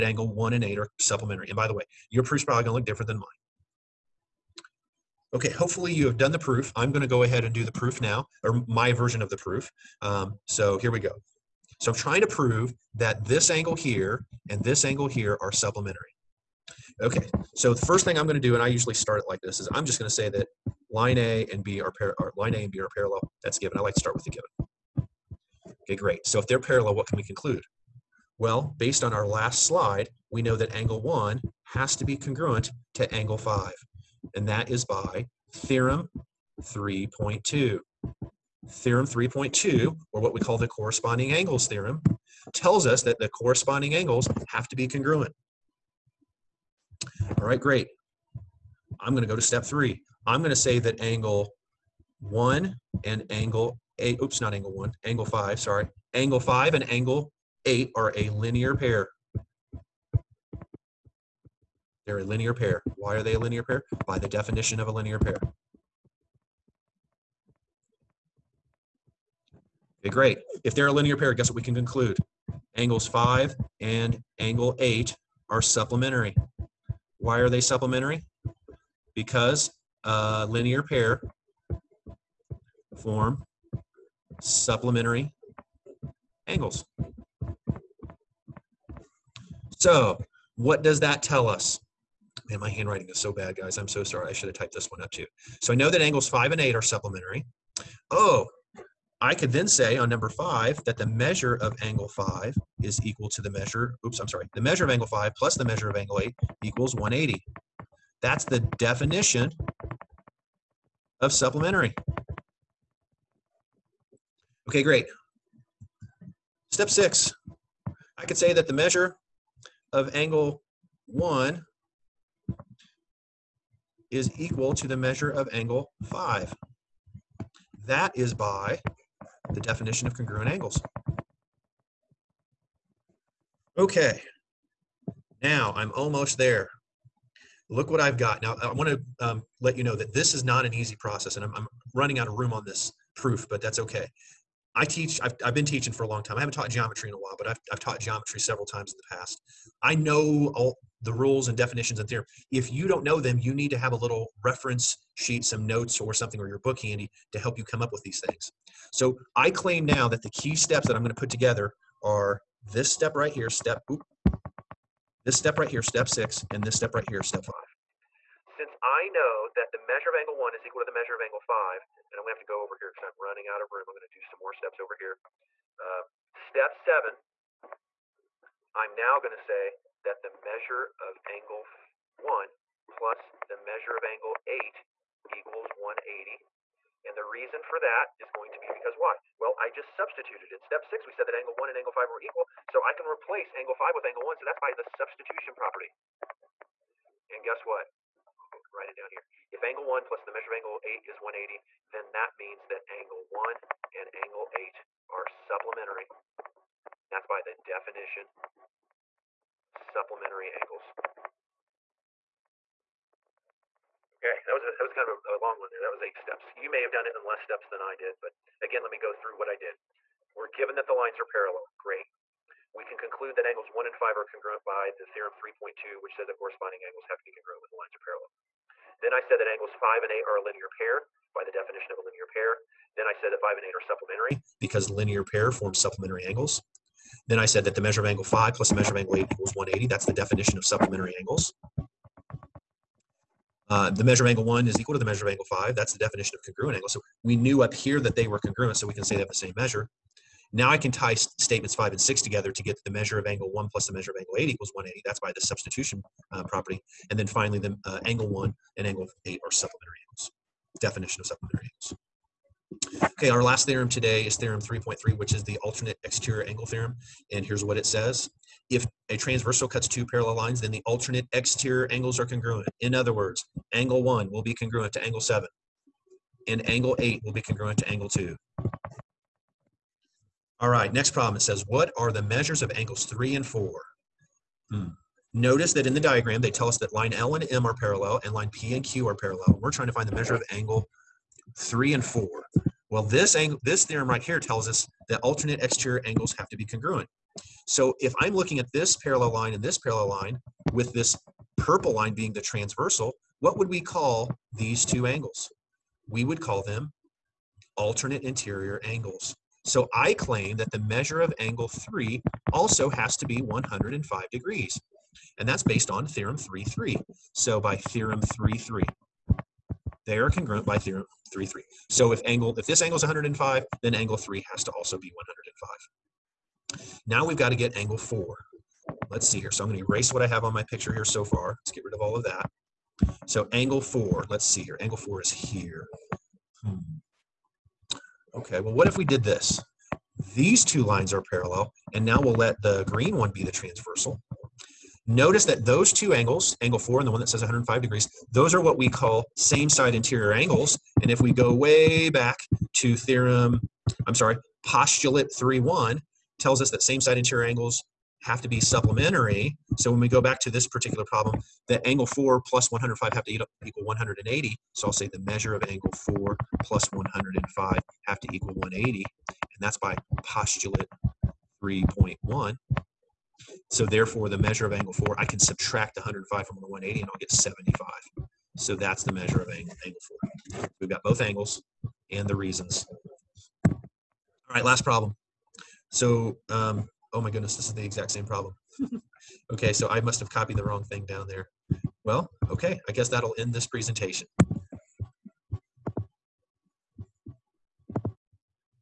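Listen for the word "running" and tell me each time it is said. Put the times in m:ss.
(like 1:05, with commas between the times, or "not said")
2:21, 2:53.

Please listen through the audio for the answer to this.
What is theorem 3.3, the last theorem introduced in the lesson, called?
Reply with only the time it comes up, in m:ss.
4:25.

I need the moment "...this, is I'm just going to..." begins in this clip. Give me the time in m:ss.
0:19.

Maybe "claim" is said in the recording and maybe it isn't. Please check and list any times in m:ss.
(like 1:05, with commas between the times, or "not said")
2:39, 5:10.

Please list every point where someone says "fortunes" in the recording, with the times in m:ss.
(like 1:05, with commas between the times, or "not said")
not said.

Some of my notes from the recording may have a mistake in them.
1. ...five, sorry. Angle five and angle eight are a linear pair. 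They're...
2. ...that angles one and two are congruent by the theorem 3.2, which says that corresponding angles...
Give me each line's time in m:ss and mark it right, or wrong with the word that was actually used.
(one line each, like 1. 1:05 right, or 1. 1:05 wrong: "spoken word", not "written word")
1. 0:55 right
2. 3:43 wrong: "five", not "two".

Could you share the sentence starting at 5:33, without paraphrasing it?
So angle four, let's see here.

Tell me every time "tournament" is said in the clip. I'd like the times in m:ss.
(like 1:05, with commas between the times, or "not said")
not said.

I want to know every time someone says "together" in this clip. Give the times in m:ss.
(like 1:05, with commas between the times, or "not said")
2:41, 4:12.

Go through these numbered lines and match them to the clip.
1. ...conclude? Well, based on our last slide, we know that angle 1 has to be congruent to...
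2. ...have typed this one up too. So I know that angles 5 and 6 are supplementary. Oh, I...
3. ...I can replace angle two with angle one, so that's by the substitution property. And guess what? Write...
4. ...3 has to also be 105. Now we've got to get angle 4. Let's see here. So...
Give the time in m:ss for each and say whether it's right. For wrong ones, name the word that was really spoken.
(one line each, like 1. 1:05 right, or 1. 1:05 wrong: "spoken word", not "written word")
1. 0:27 right
2. 1:34 wrong: "8", not "6"
3. 3:12 wrong: "five", not "two"
4. 5:24 right.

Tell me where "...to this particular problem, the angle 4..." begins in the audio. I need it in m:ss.
6:00.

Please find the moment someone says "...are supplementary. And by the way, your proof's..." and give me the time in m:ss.
0:00.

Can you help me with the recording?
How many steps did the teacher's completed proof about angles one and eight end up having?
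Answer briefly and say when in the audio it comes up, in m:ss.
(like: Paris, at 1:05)
8, at 3:36.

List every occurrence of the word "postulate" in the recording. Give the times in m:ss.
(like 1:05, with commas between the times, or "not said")
5:54, 6:10.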